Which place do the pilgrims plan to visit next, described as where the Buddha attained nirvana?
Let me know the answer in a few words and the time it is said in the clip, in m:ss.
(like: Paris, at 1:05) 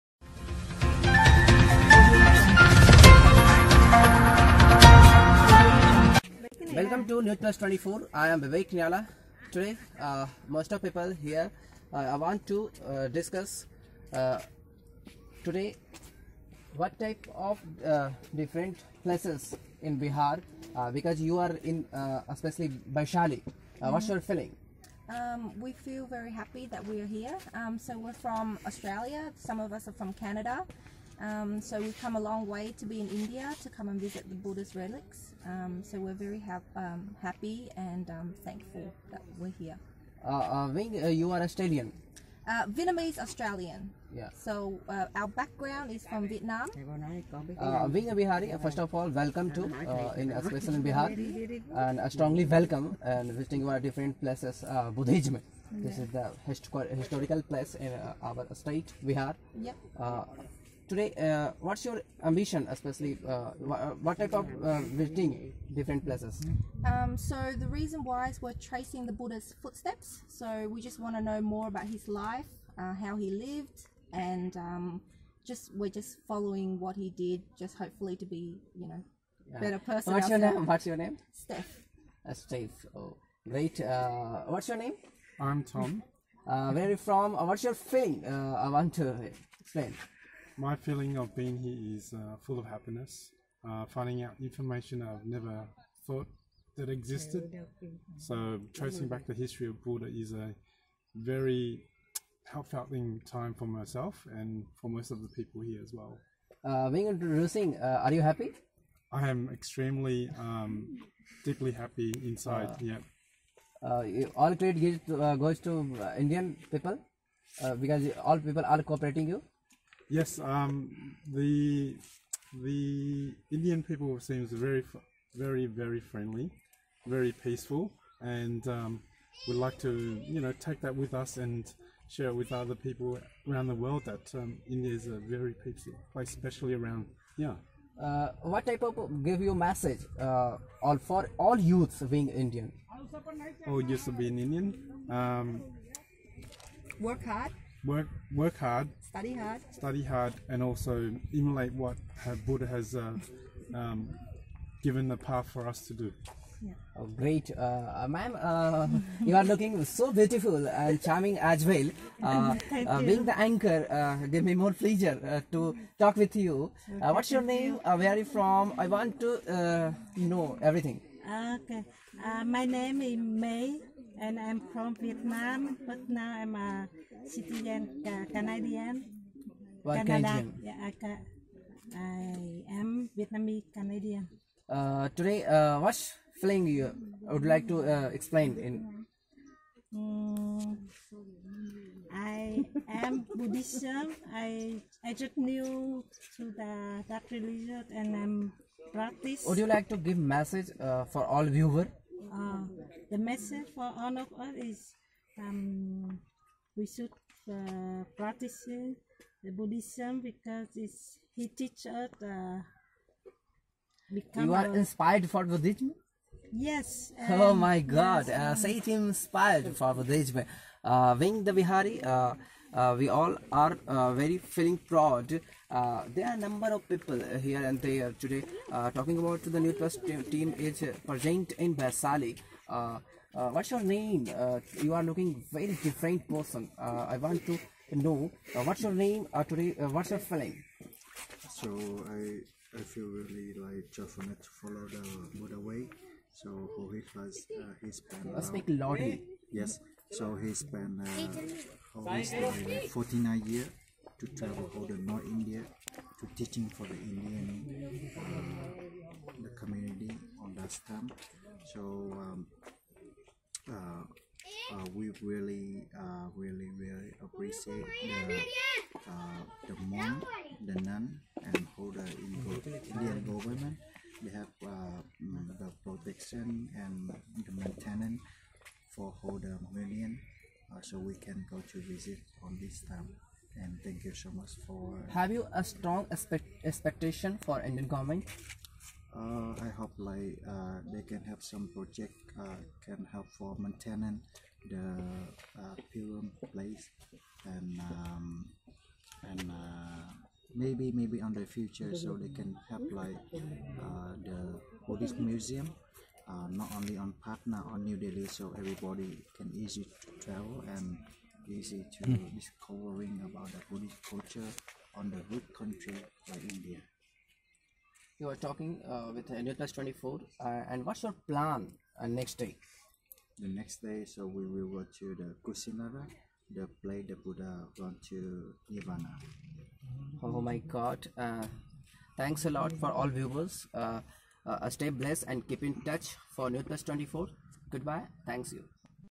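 Kusinara, at 5:25.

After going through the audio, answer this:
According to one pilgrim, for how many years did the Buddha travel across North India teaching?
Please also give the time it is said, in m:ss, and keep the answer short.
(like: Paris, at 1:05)
49, at 4:12.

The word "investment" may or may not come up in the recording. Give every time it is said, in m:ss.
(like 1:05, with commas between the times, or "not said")
not said.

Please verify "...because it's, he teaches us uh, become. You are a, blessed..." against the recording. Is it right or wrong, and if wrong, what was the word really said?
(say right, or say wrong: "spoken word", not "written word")
wrong: "inspired", not "blessed".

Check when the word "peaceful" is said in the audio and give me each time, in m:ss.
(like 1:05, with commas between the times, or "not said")
2:07, 2:15.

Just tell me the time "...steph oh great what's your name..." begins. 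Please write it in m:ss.
1:22.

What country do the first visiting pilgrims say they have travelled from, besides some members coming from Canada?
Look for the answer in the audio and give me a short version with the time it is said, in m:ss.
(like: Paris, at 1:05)
Australia, at 0:28.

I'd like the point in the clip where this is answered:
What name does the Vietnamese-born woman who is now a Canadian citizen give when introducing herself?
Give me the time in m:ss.
2:53.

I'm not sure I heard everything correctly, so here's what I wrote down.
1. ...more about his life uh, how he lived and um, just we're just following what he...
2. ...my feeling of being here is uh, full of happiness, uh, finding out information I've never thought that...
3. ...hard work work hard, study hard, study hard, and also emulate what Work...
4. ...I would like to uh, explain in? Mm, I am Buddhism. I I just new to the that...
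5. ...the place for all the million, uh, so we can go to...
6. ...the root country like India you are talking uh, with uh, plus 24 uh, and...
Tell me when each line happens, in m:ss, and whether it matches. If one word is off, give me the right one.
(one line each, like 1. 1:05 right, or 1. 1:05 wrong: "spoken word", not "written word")
1. 1:11 right
2. 1:30 right
3. 2:27 wrong: "Buddha", not "Work"
4. 3:07 right
5. 4:37 wrong: "maintenance", not "place"
6. 5:15 right.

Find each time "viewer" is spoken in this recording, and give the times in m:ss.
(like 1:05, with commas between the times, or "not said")
3:21, 5:33.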